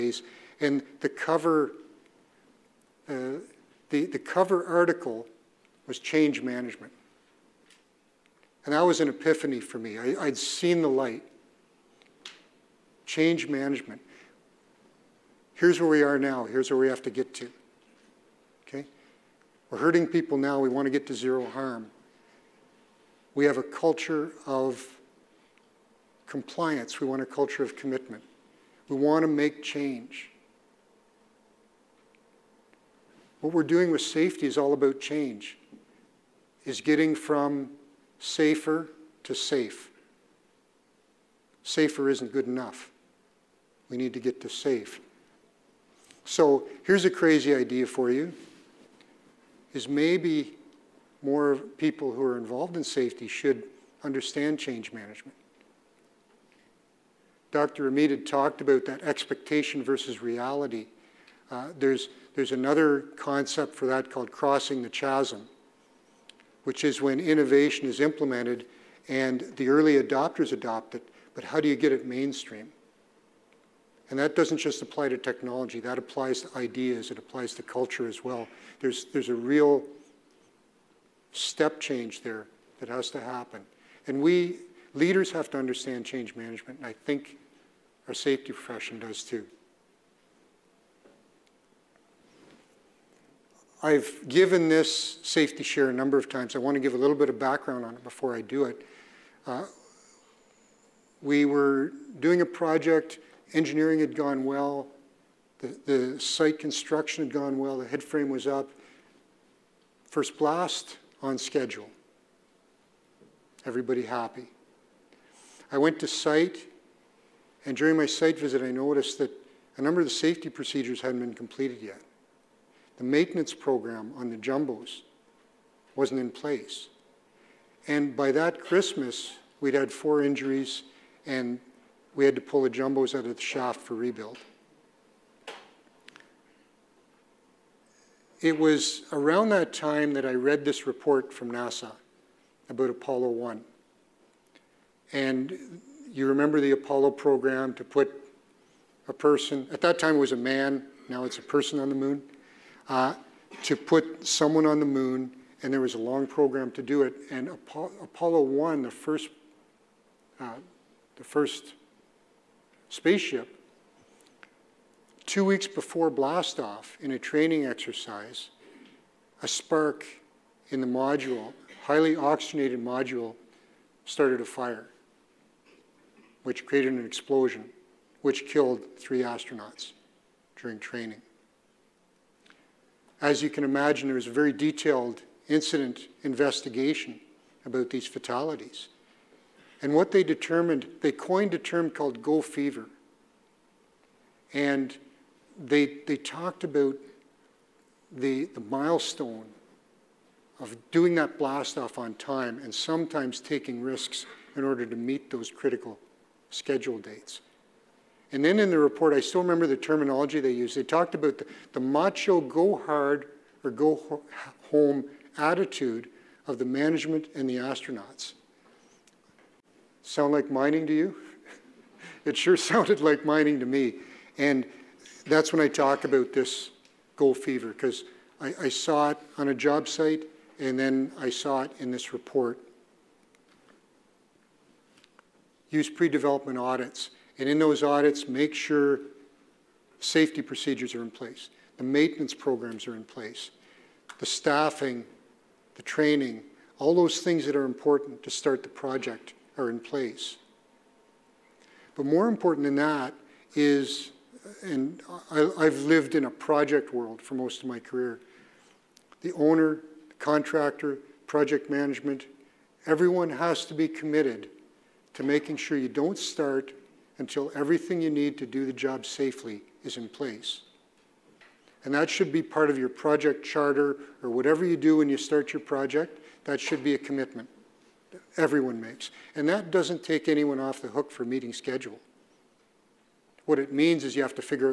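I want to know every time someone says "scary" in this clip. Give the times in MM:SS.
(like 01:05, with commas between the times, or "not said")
not said.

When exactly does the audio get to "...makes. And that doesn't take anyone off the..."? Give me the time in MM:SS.
04:38.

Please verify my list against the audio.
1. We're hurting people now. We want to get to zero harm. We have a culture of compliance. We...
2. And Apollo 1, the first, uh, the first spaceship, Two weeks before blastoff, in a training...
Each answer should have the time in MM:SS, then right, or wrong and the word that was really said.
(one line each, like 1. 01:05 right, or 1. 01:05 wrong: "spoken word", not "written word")
1. 00:19 right
2. 02:37 right.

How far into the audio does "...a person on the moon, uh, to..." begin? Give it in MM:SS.
02:31.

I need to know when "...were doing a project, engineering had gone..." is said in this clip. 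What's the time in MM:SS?
01:41.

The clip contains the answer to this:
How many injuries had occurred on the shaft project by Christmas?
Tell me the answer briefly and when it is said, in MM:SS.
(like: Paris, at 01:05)
4, at 02:09.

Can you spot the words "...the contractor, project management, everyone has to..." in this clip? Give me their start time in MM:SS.
04:20.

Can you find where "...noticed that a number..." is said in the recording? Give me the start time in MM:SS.
01:58.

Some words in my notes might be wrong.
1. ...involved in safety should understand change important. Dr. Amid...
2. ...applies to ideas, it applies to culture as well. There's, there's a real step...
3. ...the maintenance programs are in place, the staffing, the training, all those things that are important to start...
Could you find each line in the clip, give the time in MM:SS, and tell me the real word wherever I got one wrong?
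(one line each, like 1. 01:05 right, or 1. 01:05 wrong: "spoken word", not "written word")
1. 00:52 wrong: "management", not "important"
2. 01:15 right
3. 04:01 right.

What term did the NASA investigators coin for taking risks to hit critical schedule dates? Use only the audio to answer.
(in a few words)
Go fever.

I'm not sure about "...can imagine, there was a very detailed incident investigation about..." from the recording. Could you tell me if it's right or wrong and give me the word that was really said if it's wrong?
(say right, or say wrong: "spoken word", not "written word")
right.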